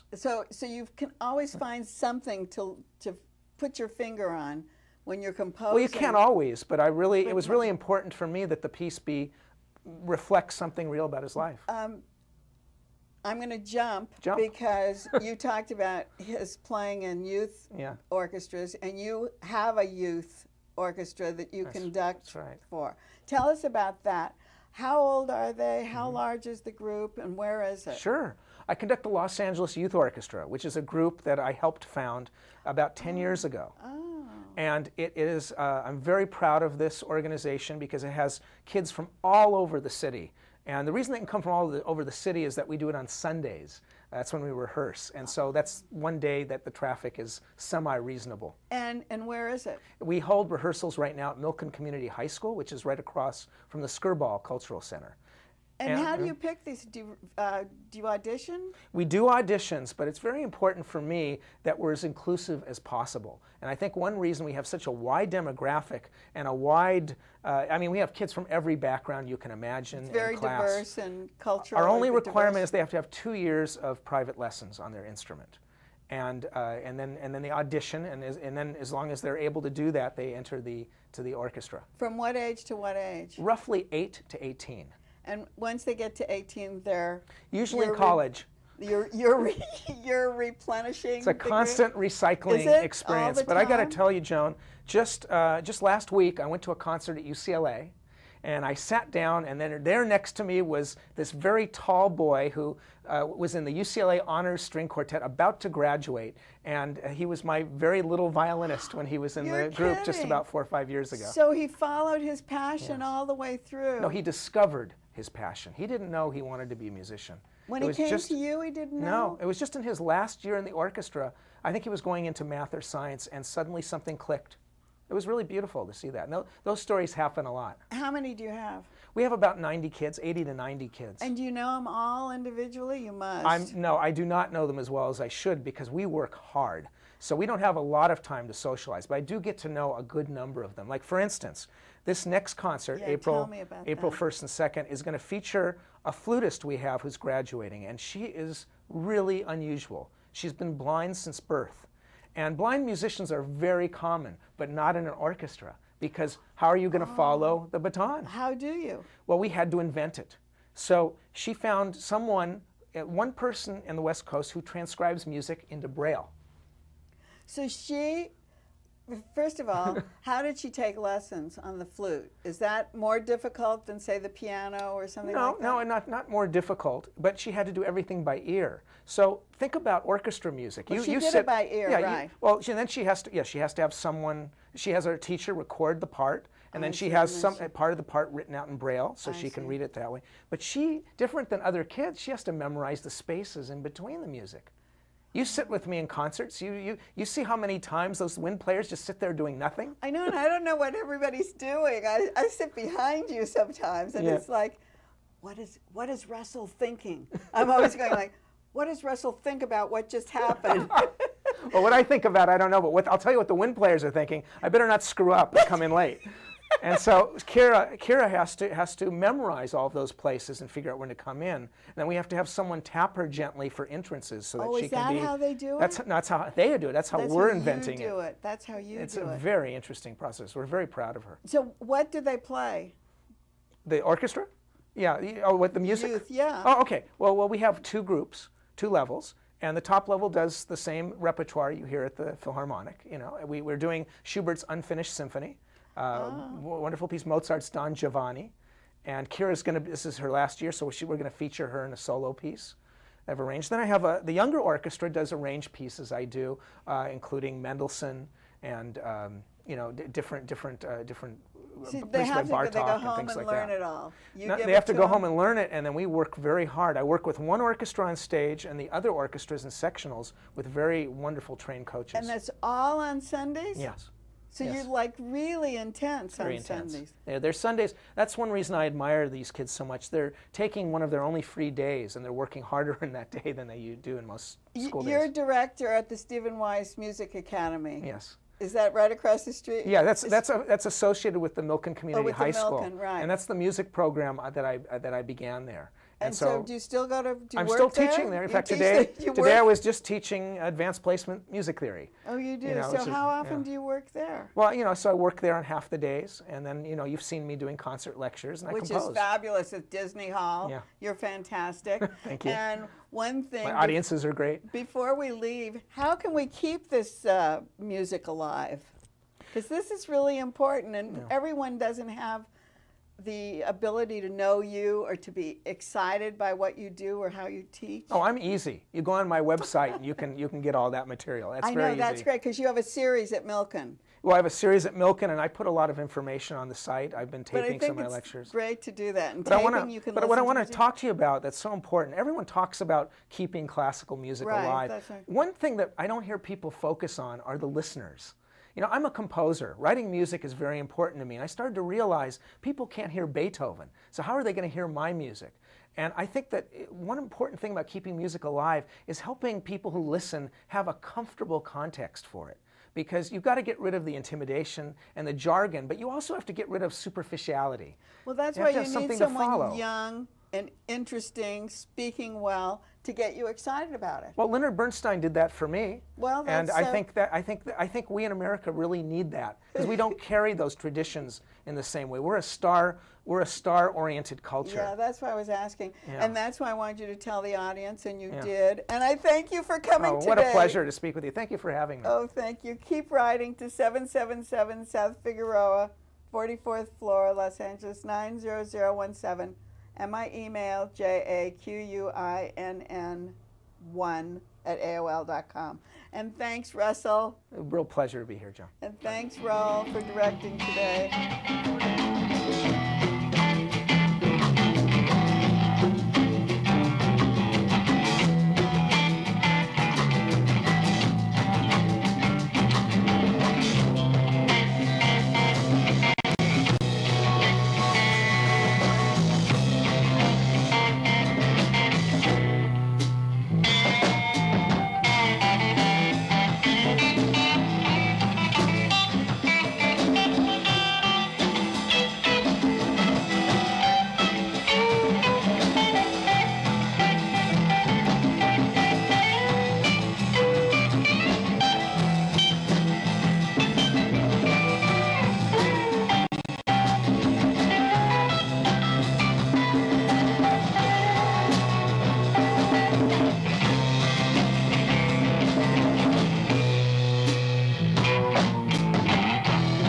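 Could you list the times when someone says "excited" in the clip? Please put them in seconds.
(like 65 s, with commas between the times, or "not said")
325 s, 373 s.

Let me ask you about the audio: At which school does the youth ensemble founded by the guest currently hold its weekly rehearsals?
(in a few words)
Milken Community High School.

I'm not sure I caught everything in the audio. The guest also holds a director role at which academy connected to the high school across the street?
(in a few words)
Stephen Wise Music Academy.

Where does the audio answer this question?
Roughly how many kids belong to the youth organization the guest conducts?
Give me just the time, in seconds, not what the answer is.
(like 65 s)
129 s.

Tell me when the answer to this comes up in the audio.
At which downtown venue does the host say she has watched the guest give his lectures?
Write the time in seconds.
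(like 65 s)
309 s.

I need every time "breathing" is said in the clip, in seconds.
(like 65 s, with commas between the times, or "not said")
not said.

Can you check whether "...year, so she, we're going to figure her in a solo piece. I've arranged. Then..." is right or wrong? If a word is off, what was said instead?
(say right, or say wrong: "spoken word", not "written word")
wrong: "feature", not "figure".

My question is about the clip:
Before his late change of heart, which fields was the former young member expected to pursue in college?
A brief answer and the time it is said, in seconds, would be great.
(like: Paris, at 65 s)
Math or science, at 122 s.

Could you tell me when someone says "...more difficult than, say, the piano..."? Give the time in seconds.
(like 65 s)
172 s.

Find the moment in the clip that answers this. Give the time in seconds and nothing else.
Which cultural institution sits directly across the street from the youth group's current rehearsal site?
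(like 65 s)
53 s.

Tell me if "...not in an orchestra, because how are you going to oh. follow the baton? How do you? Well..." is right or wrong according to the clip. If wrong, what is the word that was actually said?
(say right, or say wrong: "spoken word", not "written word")
right.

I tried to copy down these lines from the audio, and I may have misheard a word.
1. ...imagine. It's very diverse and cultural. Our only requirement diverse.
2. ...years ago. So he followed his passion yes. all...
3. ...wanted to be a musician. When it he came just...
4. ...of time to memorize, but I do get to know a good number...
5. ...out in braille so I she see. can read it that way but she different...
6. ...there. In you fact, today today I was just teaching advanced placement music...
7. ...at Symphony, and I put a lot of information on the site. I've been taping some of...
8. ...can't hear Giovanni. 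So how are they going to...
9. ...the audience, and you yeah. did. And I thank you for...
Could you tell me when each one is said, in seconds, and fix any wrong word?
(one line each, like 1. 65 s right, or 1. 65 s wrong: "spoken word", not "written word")
1. 69 s right
2. 110 s right
3. 116 s right
4. 138 s wrong: "socialize", not "memorize"
5. 188 s right
6. 298 s right
7. 334 s wrong: "Milken", not "Symphony"
8. 352 s wrong: "Beethoven", not "Giovanni"
9. 387 s right.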